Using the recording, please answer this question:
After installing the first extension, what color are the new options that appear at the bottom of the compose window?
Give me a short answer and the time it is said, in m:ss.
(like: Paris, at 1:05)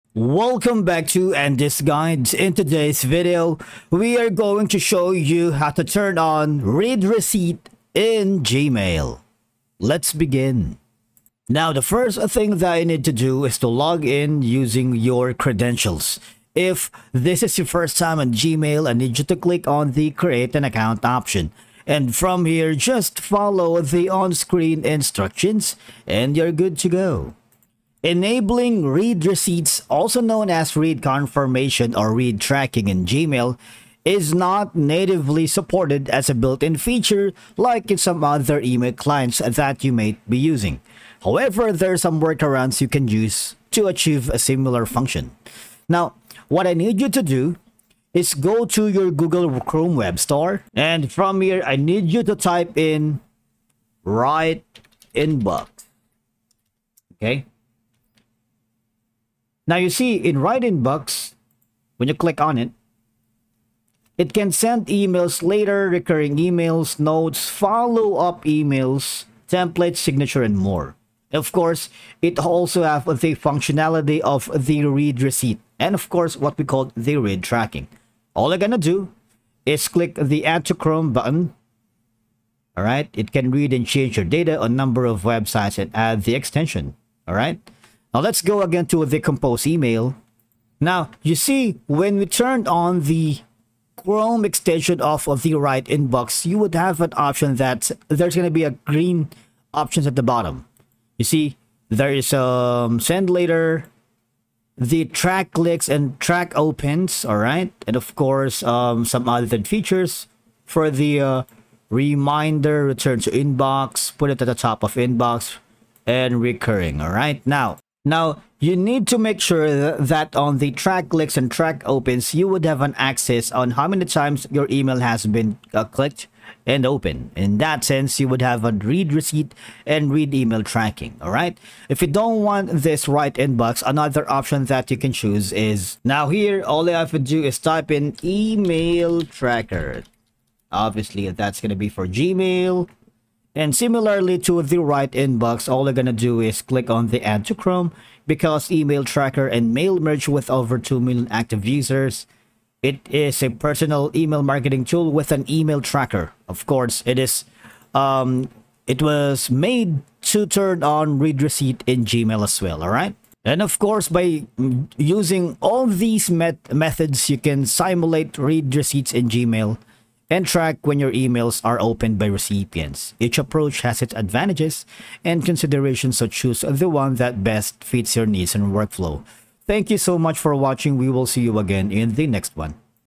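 Green, at 1:38.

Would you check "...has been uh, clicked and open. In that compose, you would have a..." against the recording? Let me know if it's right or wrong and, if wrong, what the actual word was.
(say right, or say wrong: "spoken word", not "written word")
wrong: "sense", not "compose".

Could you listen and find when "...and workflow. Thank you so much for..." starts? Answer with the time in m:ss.
2:58.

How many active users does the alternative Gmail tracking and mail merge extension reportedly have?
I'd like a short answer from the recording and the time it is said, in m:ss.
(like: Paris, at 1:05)
Over 2 million, at 2:30.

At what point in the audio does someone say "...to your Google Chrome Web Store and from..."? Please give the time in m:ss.
0:48.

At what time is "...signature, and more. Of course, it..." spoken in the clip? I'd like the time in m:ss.
1:09.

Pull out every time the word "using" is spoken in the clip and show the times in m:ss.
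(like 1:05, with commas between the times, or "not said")
0:14, 0:40, 2:44.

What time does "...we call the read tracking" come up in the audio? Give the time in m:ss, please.
1:16.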